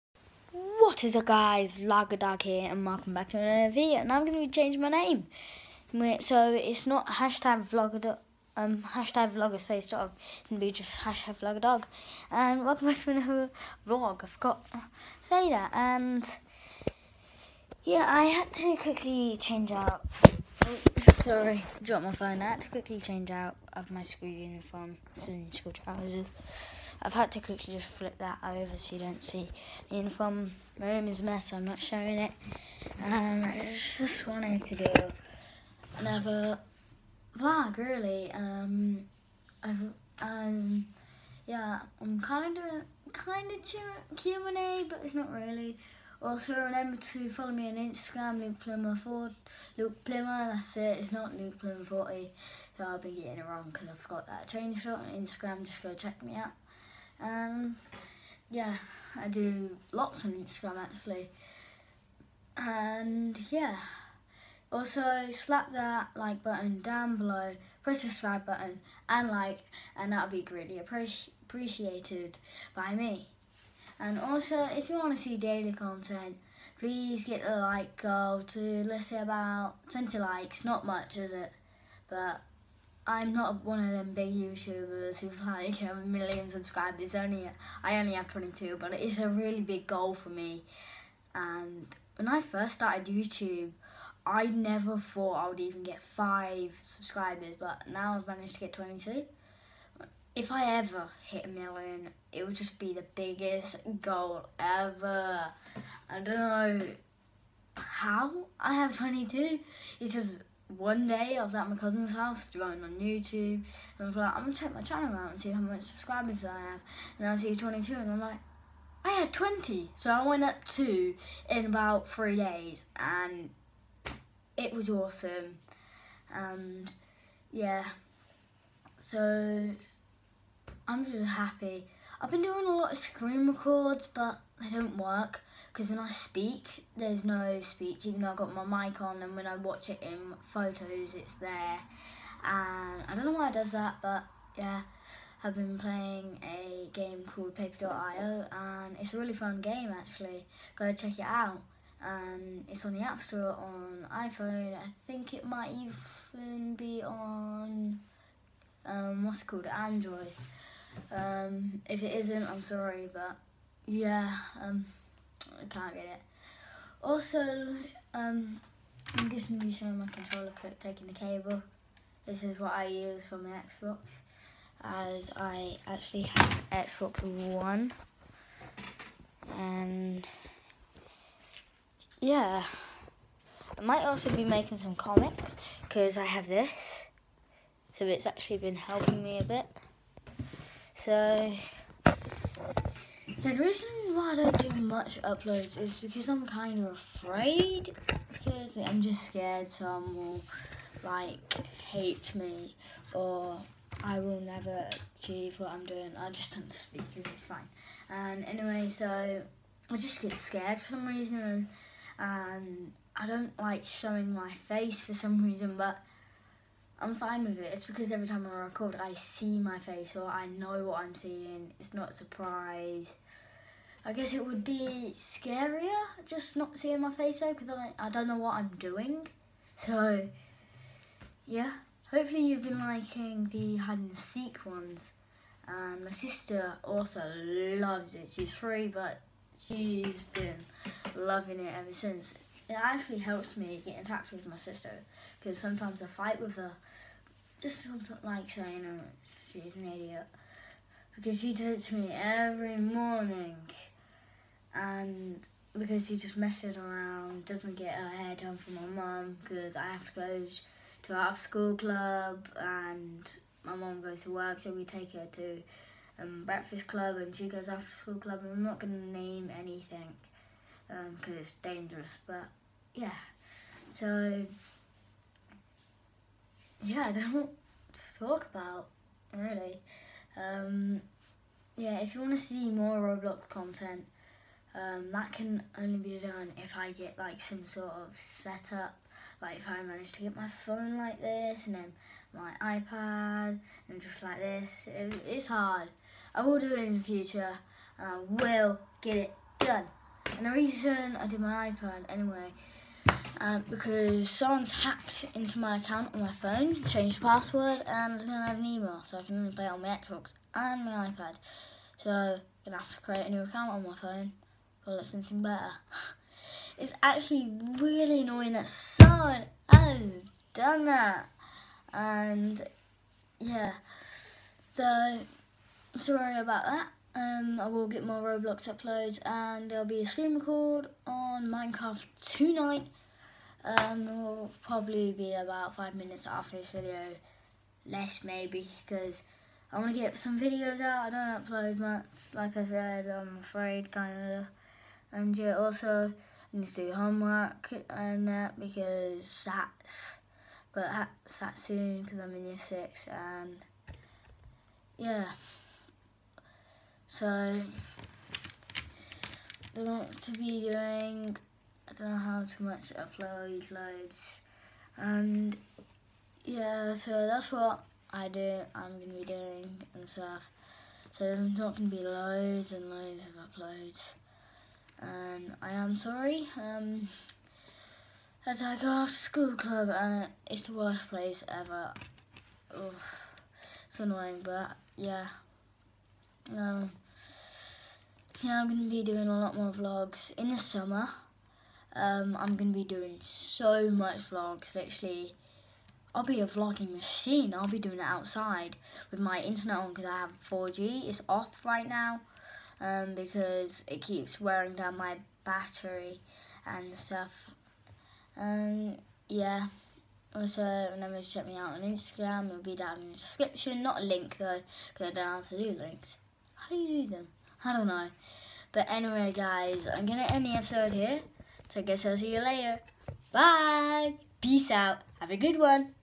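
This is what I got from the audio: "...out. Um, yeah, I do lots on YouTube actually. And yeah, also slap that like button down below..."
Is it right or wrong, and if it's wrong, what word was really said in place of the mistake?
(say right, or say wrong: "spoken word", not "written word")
wrong: "Instagram", not "YouTube".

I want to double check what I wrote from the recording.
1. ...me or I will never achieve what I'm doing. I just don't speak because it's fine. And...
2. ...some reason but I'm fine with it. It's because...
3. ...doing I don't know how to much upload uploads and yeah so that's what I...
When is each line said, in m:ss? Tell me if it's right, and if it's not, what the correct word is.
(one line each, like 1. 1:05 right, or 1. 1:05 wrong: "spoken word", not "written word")
1. 3:22 right
2. 3:35 right
3. 6:00 wrong: "loads", not "uploads".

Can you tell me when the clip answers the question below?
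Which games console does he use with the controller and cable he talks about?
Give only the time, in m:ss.
2:56.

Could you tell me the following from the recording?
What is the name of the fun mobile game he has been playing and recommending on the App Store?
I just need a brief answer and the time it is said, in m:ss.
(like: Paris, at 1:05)
Paper.io, at 2:27.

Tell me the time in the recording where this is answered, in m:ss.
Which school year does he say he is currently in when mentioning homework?
5:52.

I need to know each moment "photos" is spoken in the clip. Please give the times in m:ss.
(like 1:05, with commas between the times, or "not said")
2:20.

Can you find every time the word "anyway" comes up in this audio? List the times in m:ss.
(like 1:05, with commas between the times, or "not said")
3:28, 5:02, 6:58.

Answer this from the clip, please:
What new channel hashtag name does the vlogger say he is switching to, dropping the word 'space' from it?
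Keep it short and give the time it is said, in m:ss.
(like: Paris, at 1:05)
hashtag vlogger dog, at 0:10.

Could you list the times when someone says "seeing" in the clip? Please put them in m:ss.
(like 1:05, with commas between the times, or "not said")
3:41, 3:46.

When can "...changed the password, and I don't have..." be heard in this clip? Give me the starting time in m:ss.
5:06.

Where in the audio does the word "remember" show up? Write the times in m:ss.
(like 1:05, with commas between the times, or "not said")
0:46, 6:50.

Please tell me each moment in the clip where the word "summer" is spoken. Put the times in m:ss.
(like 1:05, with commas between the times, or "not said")
6:30.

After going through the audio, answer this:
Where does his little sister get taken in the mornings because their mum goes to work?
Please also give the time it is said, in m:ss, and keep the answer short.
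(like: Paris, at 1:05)
breakfast club, at 4:26.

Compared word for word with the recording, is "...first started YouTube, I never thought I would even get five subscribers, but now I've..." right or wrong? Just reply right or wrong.
right.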